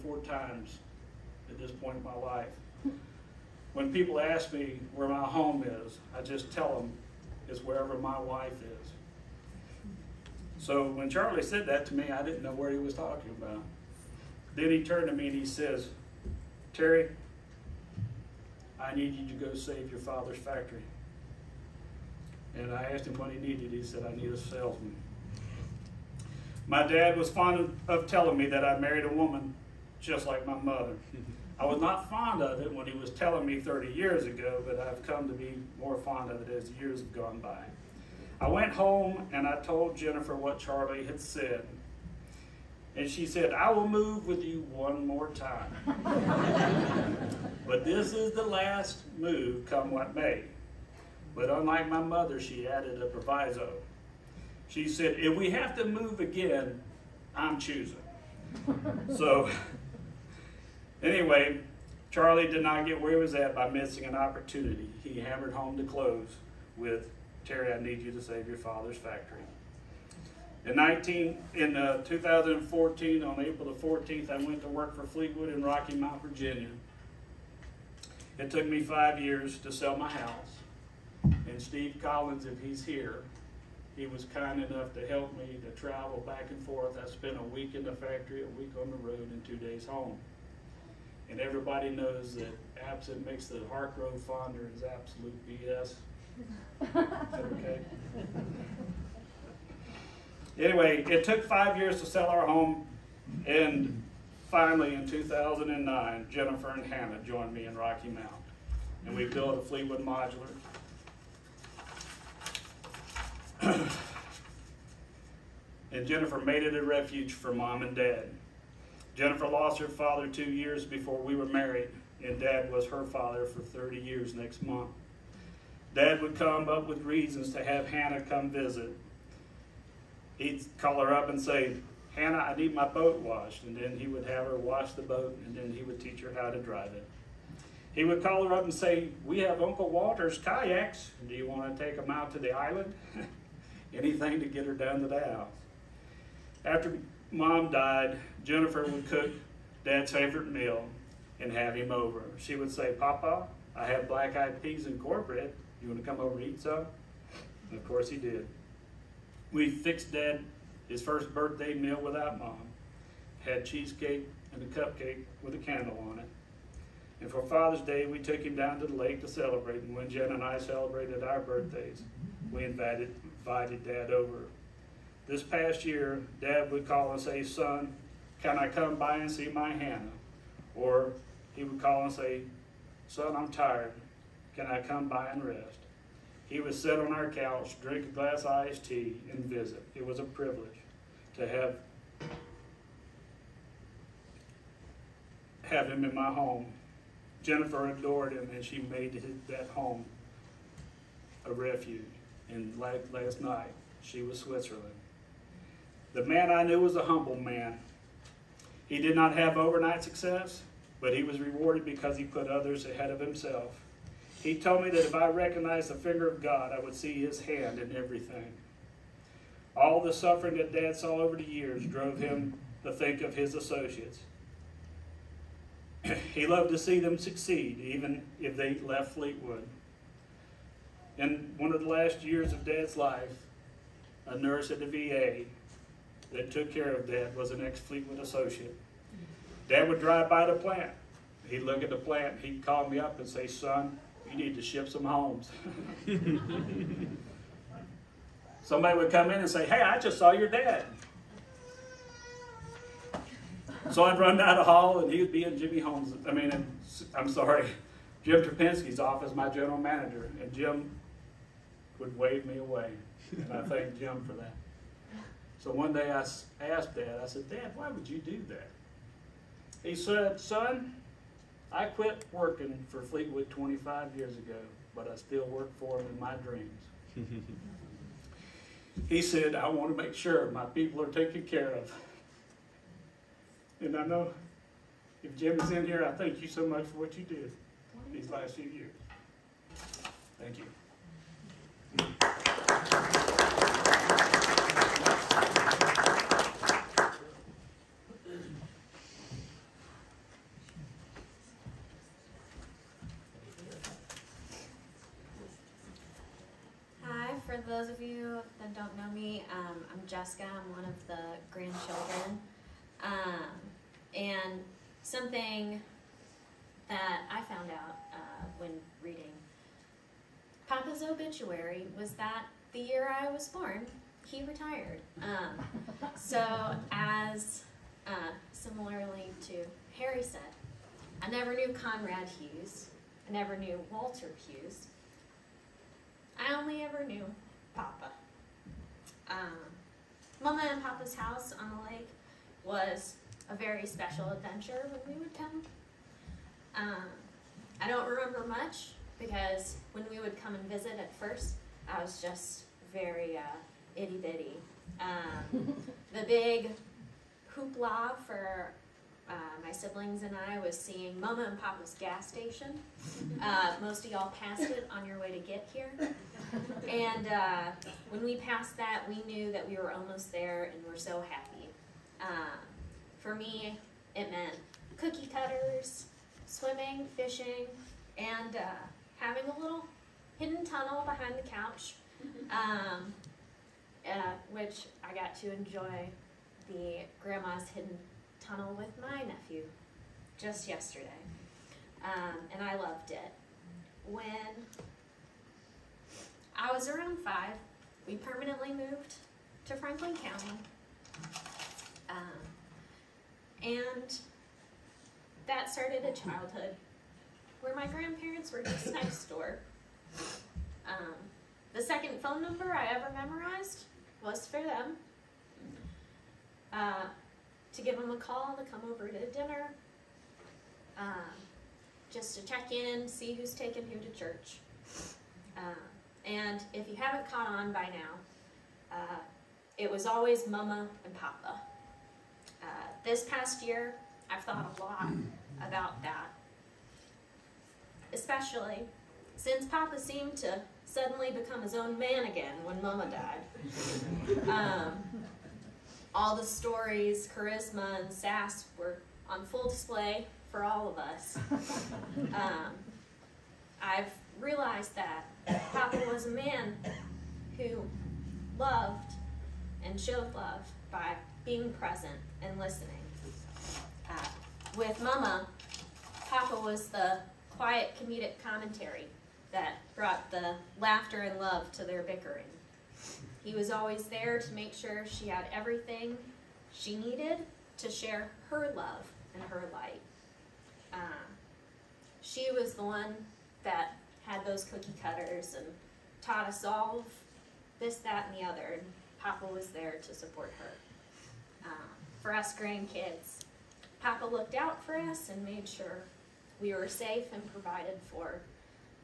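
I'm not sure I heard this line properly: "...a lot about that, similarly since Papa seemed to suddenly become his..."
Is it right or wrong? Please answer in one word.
wrong.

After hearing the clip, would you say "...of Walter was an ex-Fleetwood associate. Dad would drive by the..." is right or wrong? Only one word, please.
wrong.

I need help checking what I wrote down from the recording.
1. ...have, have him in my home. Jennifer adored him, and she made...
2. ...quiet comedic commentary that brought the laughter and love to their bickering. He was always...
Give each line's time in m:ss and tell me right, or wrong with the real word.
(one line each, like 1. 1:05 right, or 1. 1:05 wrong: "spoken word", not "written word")
1. 3:11 right
2. 7:47 right.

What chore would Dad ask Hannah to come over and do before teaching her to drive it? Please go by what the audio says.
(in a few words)
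wash the boat.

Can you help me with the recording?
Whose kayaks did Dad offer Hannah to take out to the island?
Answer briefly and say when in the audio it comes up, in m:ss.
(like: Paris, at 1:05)
Uncle Walter's, at 2:19.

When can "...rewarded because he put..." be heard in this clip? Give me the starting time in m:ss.
3:31.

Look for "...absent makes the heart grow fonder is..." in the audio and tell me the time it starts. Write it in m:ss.
1:32.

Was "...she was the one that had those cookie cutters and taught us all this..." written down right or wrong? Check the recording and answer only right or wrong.
right.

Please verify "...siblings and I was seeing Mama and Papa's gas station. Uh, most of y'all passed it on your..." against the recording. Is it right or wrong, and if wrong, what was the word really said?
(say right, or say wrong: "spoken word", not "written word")
right.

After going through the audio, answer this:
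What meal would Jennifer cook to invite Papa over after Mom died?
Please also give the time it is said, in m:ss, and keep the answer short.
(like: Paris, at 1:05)
black-eyed peas and cornbread, at 2:33.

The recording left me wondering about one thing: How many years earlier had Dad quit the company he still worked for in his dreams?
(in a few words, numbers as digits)
25.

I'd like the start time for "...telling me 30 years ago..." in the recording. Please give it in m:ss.
0:33.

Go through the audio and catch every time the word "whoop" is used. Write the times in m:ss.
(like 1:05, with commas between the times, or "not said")
not said.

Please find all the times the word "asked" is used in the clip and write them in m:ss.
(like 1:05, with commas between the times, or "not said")
0:22, 4:26.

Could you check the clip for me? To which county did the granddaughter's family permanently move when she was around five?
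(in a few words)
Franklin County.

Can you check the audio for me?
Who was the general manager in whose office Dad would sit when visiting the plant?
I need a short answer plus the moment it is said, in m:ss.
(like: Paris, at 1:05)
Jim Trapinski, at 4:18.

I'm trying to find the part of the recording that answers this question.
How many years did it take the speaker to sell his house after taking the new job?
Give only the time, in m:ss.
1:18.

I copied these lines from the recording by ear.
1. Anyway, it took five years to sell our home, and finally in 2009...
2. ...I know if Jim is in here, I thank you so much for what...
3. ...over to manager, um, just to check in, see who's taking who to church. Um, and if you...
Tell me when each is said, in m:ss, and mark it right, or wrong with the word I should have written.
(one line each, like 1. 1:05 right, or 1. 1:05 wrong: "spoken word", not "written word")
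1. 1:40 right
2. 4:43 right
3. 6:58 wrong: "dinner", not "manager".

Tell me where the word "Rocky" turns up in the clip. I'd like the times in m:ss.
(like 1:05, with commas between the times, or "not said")
1:15, 1:47.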